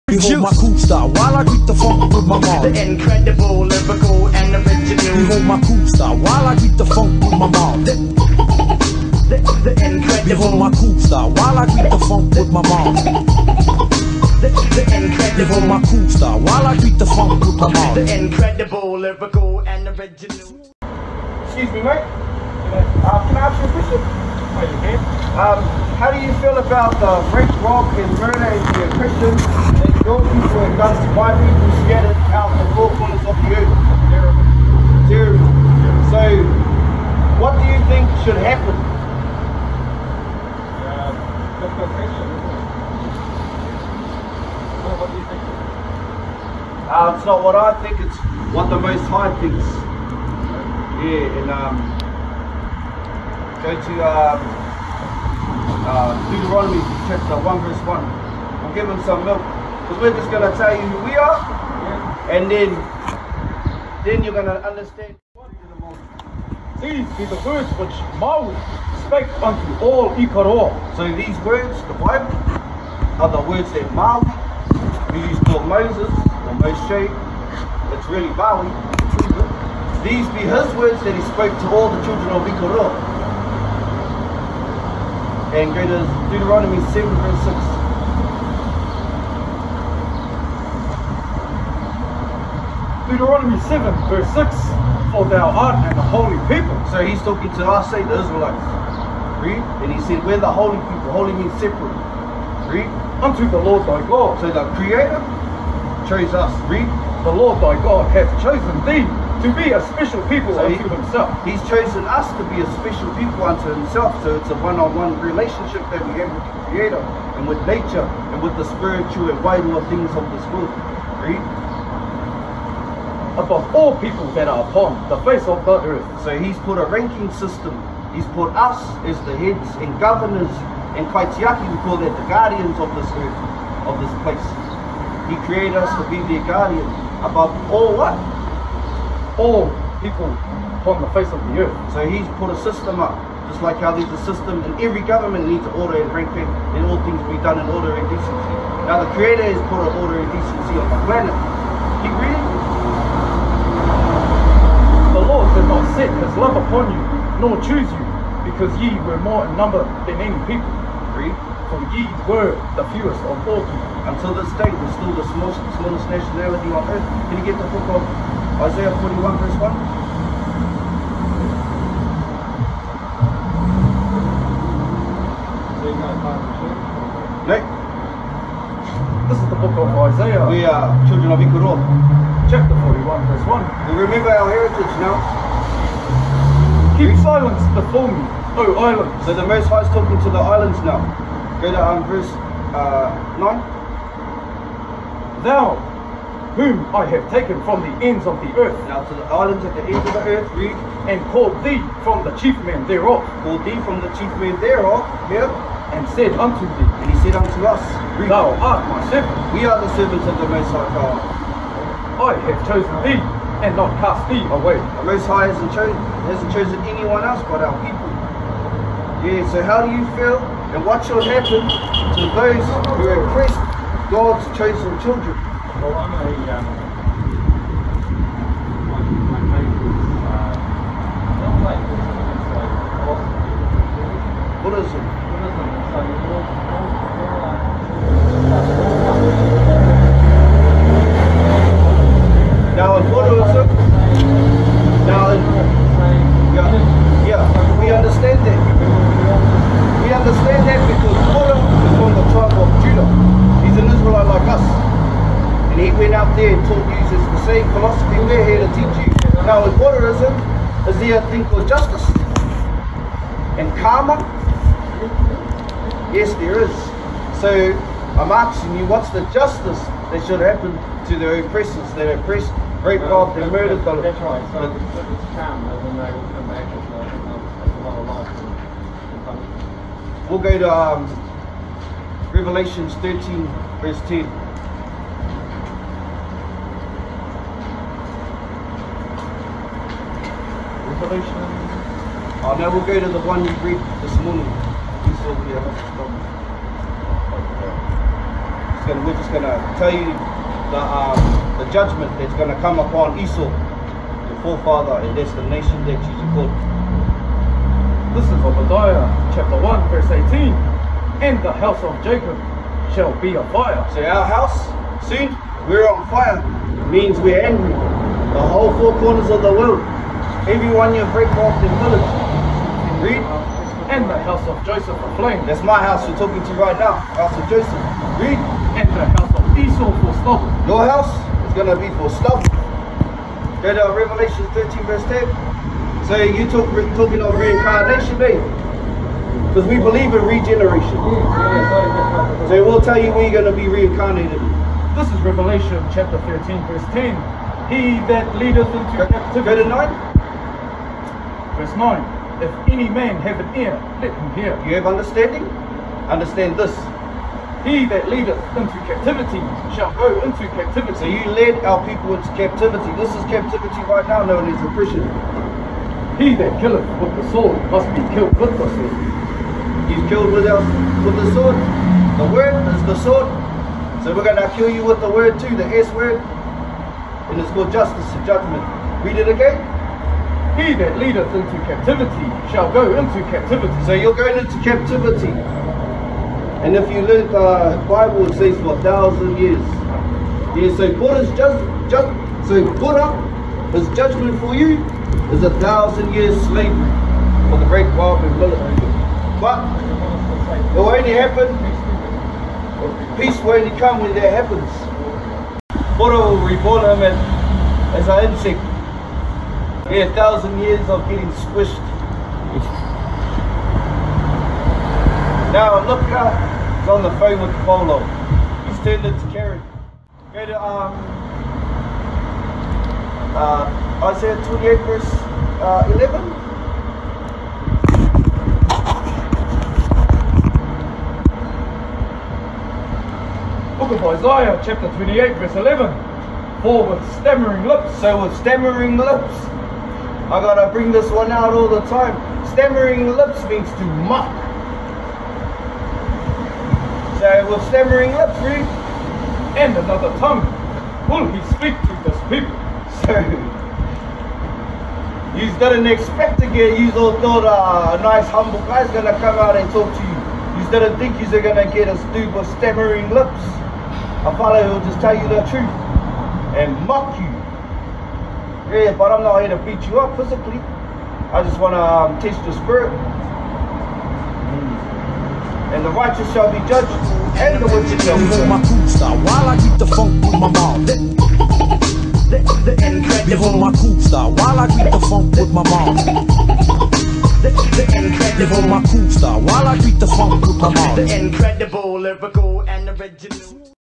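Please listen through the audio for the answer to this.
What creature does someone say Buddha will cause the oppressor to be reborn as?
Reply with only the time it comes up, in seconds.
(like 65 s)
408 s.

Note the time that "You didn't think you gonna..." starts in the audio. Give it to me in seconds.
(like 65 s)
460 s.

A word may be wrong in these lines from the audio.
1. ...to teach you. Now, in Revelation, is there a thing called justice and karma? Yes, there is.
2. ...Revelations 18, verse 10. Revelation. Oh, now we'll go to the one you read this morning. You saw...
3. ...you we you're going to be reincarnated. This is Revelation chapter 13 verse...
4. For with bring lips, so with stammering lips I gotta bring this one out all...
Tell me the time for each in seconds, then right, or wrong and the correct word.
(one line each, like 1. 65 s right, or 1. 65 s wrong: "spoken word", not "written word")
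1. 258 s wrong: "Buddhism", not "Revelation"
2. 282 s wrong: "13", not "18"
3. 342 s right
4. 436 s wrong: "stammering", not "bring".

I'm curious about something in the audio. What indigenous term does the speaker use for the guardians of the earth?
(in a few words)
Kaitiaki.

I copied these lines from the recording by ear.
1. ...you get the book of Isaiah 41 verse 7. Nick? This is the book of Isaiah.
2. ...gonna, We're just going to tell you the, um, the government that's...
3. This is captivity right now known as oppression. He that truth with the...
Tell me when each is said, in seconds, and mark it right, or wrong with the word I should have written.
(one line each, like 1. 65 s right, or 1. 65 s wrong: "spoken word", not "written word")
1. 167 s wrong: "1", not "7"
2. 298 s wrong: "judgment", not "government"
3. 362 s wrong: "killeth", not "truth".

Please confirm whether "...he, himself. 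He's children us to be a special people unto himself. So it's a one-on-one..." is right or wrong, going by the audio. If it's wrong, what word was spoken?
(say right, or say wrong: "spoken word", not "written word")
wrong: "chosen", not "children".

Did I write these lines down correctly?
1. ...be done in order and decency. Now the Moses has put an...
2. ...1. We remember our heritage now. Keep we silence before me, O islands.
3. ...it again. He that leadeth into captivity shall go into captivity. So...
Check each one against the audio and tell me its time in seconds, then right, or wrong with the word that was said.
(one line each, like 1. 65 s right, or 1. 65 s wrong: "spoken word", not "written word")
1. 147 s wrong: "Creator", not "Moses"
2. 183 s right
3. 379 s right.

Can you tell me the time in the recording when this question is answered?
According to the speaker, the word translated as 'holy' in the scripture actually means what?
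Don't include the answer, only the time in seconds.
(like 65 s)
101 s.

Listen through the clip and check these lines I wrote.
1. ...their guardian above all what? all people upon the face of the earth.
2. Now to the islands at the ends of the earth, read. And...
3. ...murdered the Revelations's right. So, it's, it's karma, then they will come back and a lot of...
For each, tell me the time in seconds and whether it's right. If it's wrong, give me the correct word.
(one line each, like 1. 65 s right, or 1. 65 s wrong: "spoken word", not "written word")
1. 136 s right
2. 198 s right
3. 273 s wrong: "That", not "Revelations".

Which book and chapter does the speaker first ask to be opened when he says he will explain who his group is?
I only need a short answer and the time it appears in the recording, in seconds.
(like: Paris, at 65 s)
Deuteronomy chapter 1, at 56 s.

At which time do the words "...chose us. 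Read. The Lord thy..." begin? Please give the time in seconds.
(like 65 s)
106 s.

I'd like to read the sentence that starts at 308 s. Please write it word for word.
This is Obadiah chapter 1, verse 18.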